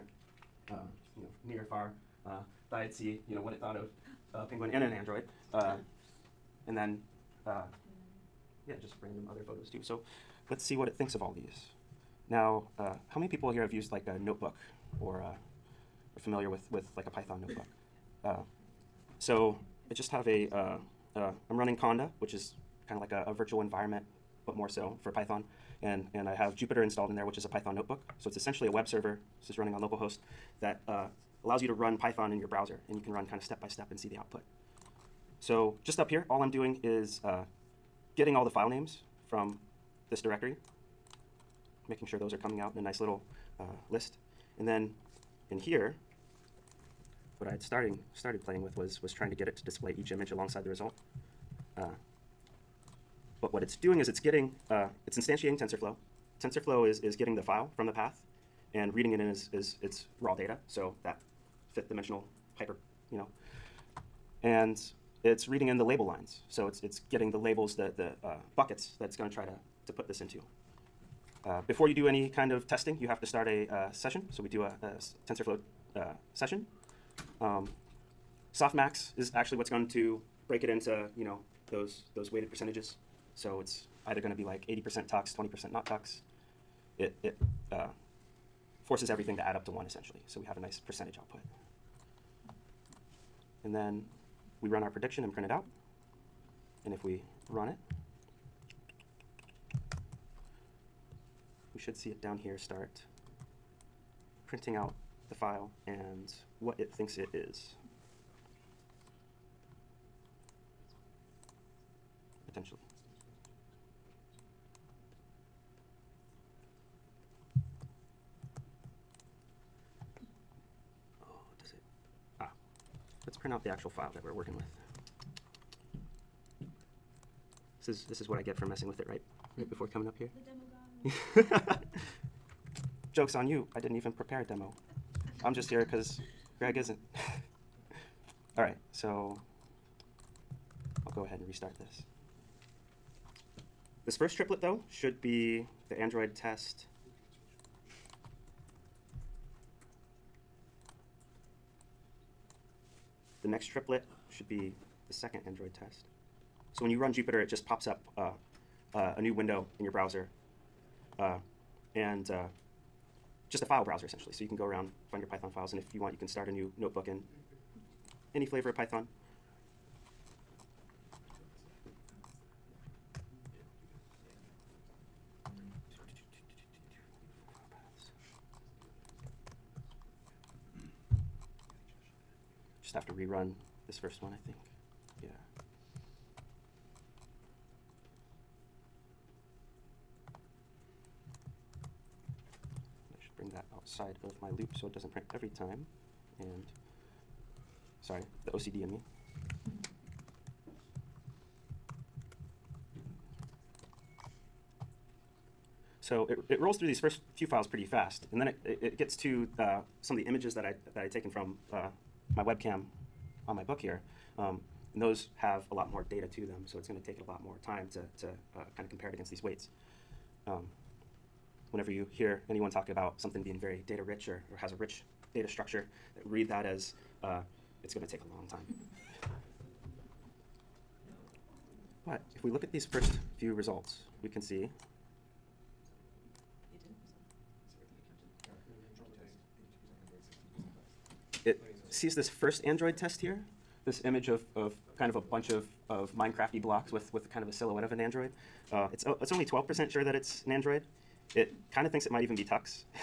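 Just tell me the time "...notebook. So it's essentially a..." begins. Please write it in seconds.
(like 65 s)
27 s.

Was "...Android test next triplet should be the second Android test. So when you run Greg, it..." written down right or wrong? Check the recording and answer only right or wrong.
wrong.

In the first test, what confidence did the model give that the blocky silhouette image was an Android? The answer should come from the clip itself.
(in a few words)
12%.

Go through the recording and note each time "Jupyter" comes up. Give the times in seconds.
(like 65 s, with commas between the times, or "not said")
26 s, 157 s.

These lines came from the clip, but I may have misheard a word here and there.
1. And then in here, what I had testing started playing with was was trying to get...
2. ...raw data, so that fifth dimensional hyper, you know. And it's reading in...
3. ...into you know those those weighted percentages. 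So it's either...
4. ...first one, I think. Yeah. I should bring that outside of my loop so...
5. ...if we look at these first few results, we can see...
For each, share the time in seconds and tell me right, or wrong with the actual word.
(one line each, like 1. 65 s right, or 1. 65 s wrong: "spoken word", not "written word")
1. 44 s wrong: "starting", not "testing"
2. 60 s right
3. 80 s right
4. 183 s right
5. 232 s right.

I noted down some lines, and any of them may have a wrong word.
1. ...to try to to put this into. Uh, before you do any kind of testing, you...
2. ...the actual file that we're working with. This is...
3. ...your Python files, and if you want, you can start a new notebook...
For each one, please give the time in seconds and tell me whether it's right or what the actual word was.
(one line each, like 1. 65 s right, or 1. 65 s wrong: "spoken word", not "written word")
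1. 69 s right
2. 123 s right
3. 165 s right.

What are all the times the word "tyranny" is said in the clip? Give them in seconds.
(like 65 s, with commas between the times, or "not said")
not said.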